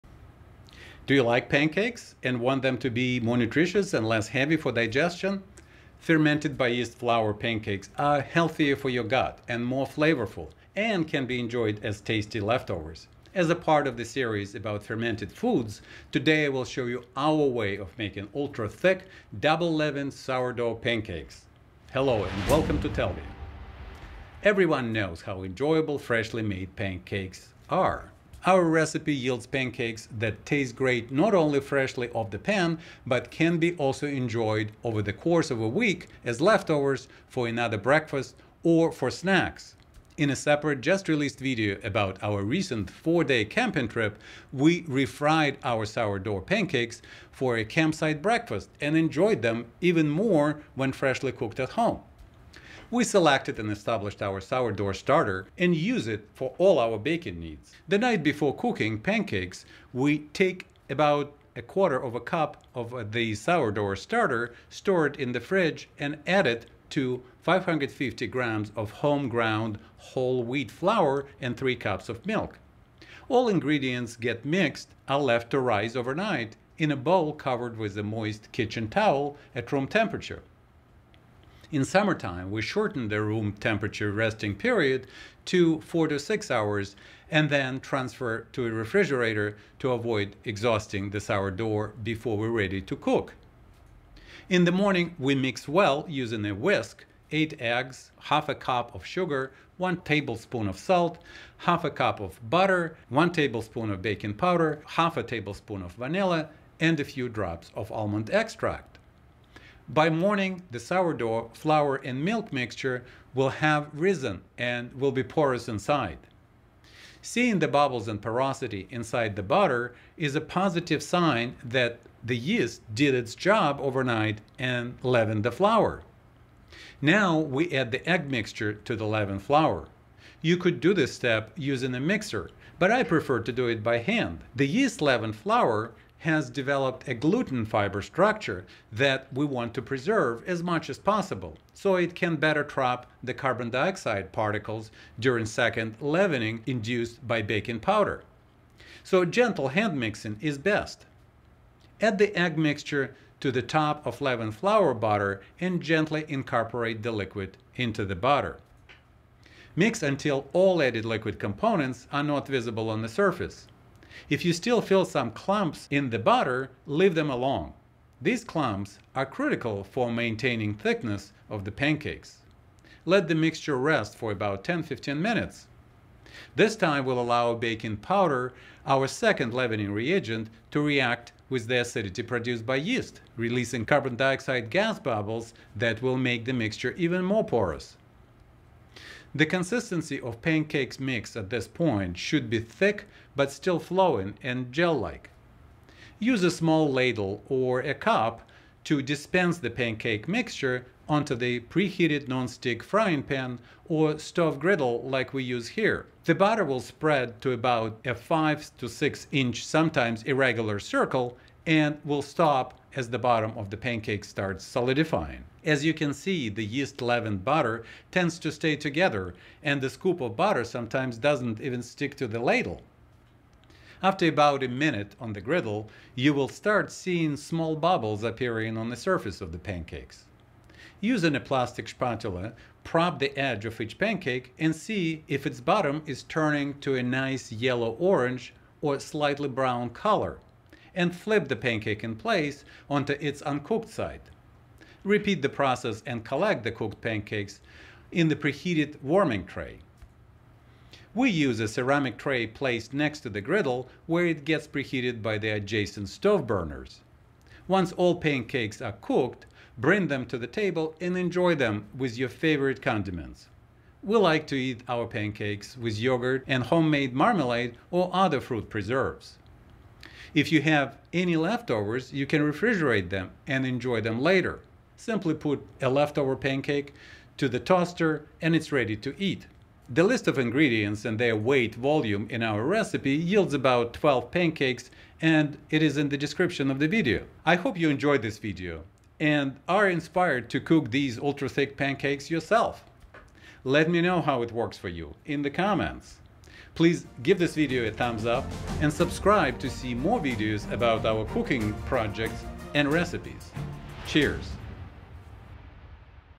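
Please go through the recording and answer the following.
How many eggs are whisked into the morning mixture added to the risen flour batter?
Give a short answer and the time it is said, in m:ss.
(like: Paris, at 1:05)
8, at 1:37.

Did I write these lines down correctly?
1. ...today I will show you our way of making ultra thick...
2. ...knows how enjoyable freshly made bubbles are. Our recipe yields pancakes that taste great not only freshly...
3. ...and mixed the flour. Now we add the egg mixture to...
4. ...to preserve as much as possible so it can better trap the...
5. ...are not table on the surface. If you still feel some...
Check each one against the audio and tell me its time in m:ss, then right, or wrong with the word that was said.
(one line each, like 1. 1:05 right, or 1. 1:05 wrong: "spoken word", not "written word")
1. 0:16 right
2. 0:24 wrong: "pancakes", not "bubbles"
3. 2:04 wrong: "leavened", not "mixed"
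4. 2:19 right
5. 2:42 wrong: "visible", not "table".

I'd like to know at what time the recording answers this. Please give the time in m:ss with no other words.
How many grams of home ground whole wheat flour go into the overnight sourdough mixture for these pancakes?
1:07.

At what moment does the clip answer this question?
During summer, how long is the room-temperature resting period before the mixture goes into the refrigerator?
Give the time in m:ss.
1:25.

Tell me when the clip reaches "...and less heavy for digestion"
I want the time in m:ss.
0:03.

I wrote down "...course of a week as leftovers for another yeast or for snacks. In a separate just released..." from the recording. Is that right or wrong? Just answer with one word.
wrong.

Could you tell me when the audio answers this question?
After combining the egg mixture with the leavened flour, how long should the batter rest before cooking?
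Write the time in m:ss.
2:54.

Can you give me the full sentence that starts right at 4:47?
I hope you enjoyed this video and are inspired to cook these ultra thick pancakes yourself.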